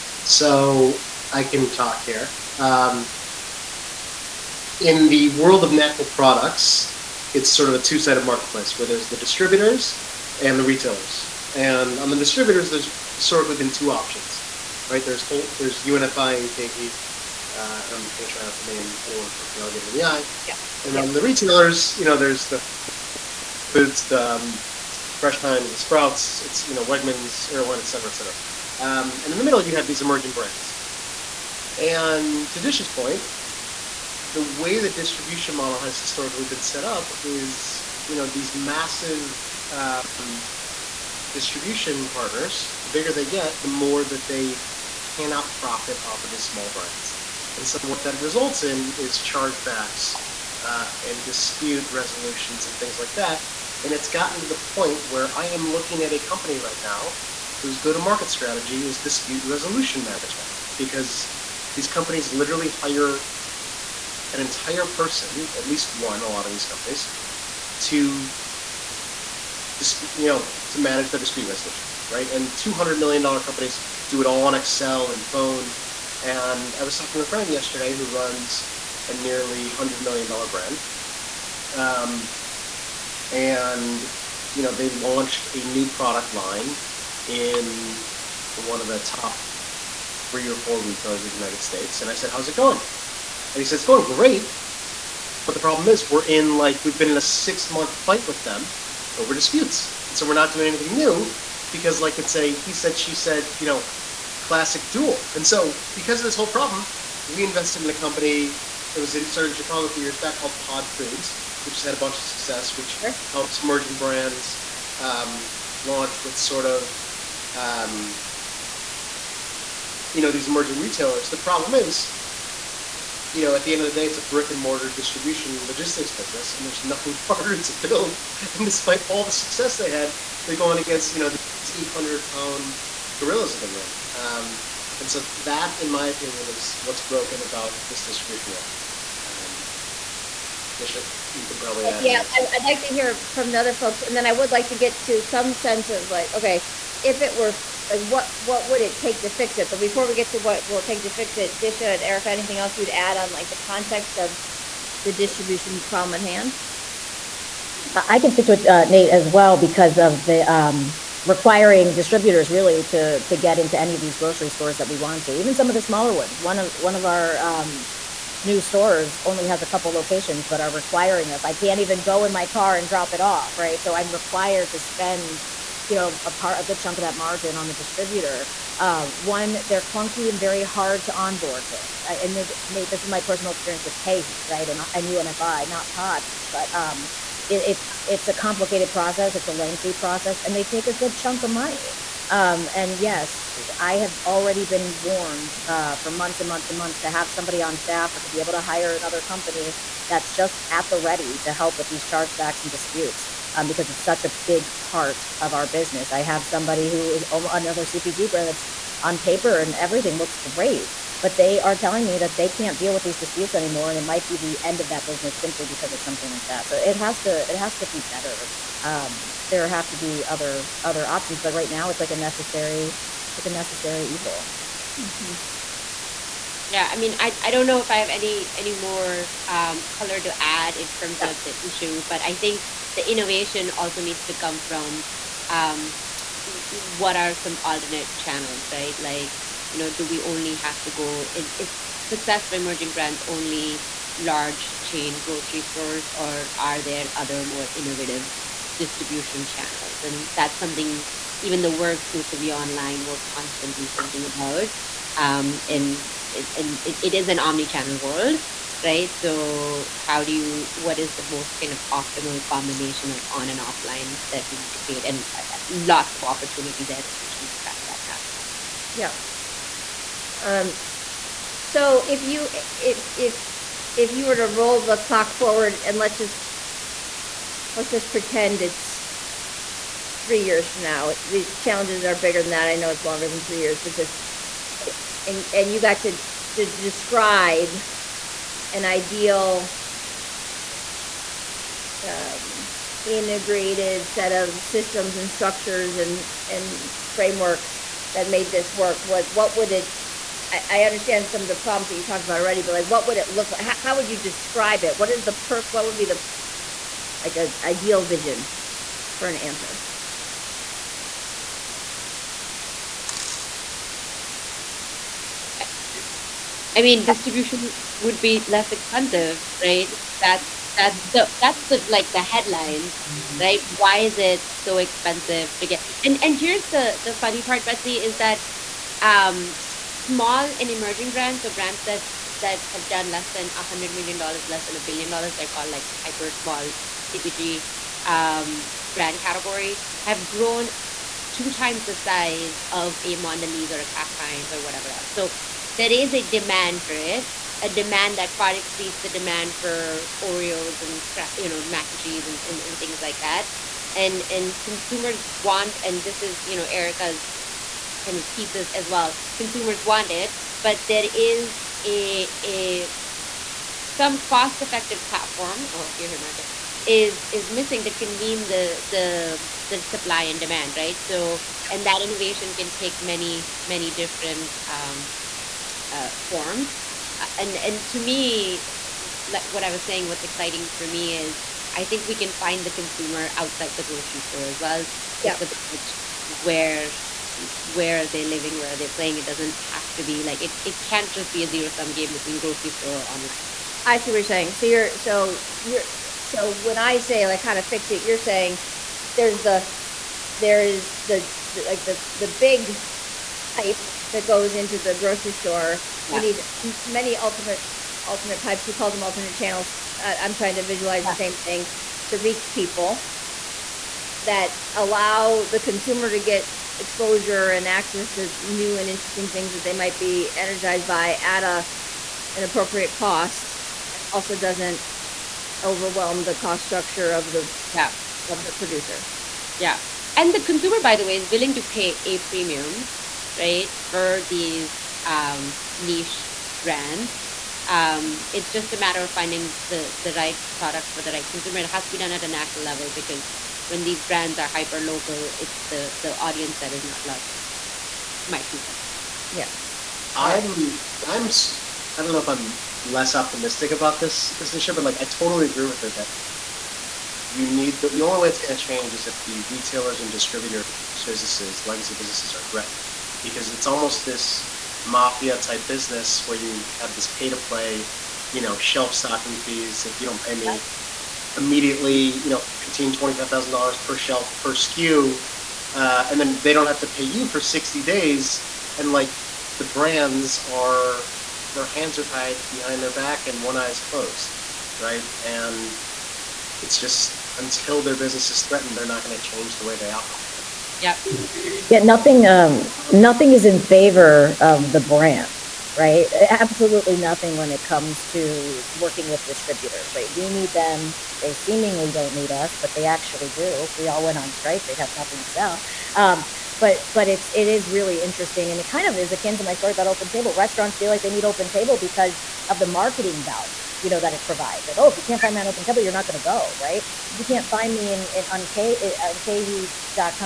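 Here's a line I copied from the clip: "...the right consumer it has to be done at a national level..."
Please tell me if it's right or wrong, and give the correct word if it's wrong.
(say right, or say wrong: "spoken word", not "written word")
right.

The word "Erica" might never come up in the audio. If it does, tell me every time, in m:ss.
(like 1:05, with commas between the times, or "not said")
2:32, 5:56.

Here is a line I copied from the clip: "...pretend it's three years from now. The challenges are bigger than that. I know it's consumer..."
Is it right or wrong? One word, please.
wrong.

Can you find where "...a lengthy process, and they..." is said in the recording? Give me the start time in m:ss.
3:09.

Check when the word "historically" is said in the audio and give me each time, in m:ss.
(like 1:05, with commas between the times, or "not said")
0:13, 0:35.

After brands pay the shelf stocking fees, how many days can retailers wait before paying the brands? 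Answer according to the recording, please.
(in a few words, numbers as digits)
60 days.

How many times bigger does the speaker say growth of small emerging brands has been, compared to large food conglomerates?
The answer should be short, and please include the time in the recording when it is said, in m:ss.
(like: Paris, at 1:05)
2 times, at 5:41.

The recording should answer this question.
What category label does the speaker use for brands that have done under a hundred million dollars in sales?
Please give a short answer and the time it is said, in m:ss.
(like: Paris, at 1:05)
hyper small CPG, at 5:36.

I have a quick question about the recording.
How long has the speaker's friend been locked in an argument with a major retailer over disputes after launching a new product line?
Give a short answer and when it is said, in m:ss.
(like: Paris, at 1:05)
6 months, at 1:37.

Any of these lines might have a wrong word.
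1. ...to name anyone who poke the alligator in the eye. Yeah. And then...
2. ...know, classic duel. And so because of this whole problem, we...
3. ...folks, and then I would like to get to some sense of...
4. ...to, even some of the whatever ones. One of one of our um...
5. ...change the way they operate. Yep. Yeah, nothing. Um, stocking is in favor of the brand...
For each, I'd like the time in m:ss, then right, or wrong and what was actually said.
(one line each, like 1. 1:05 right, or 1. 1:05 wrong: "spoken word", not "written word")
1. 0:18 right
2. 1:43 right
3. 2:23 right
4. 2:45 wrong: "smaller", not "whatever"
5. 8:09 wrong: "nothing", not "stocking".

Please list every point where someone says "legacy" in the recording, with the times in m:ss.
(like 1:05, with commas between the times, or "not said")
7:41.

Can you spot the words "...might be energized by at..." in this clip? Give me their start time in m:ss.
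6:59.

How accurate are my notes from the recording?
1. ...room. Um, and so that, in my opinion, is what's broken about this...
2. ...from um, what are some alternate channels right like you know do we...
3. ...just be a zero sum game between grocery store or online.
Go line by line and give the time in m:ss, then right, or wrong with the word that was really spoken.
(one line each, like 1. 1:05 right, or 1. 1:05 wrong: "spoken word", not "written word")
1. 2:13 right
2. 3:54 right
3. 6:31 right.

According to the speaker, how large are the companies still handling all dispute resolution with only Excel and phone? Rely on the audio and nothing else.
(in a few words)
$200 million.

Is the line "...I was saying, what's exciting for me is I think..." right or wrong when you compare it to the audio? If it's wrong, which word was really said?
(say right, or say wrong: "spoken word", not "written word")
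right.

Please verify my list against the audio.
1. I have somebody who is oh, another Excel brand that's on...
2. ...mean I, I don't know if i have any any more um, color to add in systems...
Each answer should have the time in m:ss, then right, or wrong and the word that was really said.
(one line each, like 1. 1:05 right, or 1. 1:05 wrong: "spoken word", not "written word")
1. 3:26 wrong: "CPG", not "Excel"
2. 3:46 wrong: "terms", not "systems".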